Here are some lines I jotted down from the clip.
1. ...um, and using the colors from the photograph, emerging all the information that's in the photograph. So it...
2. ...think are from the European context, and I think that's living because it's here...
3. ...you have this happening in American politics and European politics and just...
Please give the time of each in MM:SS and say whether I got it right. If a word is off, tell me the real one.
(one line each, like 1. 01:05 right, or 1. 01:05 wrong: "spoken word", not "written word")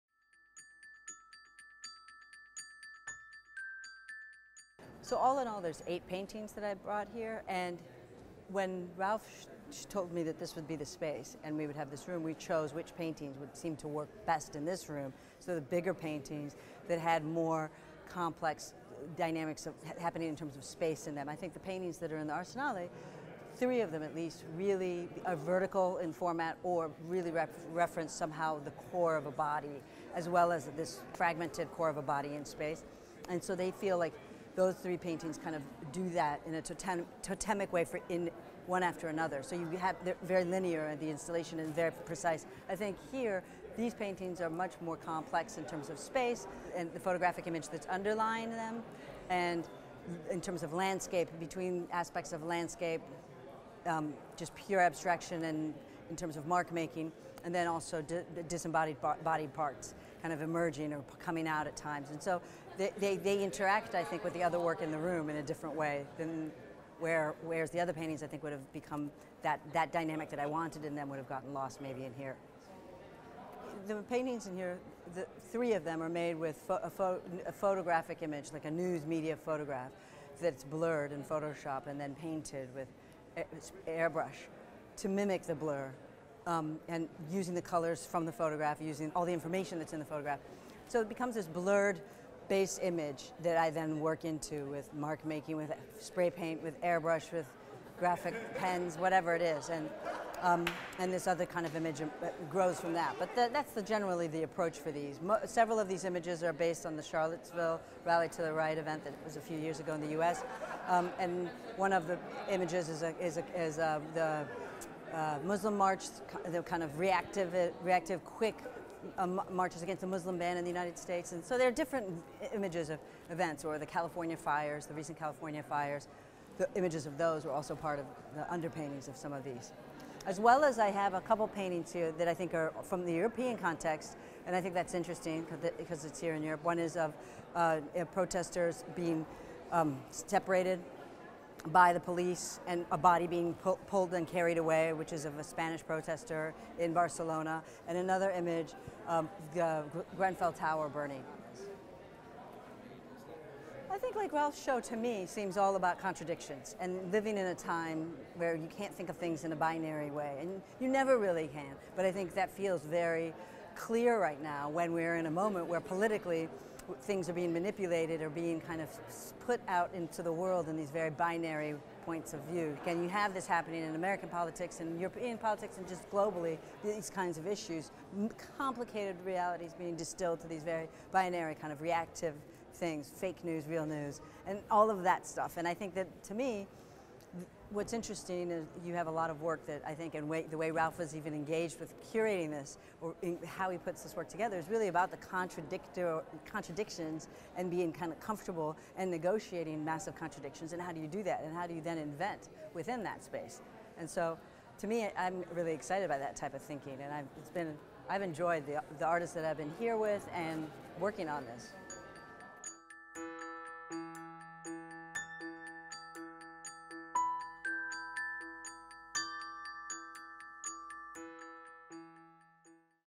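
1. 01:26 wrong: "using", not "emerging"
2. 02:12 wrong: "interesting", not "living"
3. 02:53 right.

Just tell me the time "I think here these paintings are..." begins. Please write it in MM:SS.
00:42.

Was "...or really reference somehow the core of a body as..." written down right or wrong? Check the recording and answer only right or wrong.
right.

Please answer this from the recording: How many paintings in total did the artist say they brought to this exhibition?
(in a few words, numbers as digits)
8.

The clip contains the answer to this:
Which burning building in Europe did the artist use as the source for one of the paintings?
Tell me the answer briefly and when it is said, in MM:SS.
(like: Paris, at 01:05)
Grenfell Tower, at 02:30.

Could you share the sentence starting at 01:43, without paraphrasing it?
But the, that's the, generally the approach for these.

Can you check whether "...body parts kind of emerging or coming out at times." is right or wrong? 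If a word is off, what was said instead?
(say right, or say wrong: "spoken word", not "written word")
right.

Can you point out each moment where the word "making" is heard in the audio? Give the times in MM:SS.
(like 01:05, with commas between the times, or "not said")
00:56, 01:35.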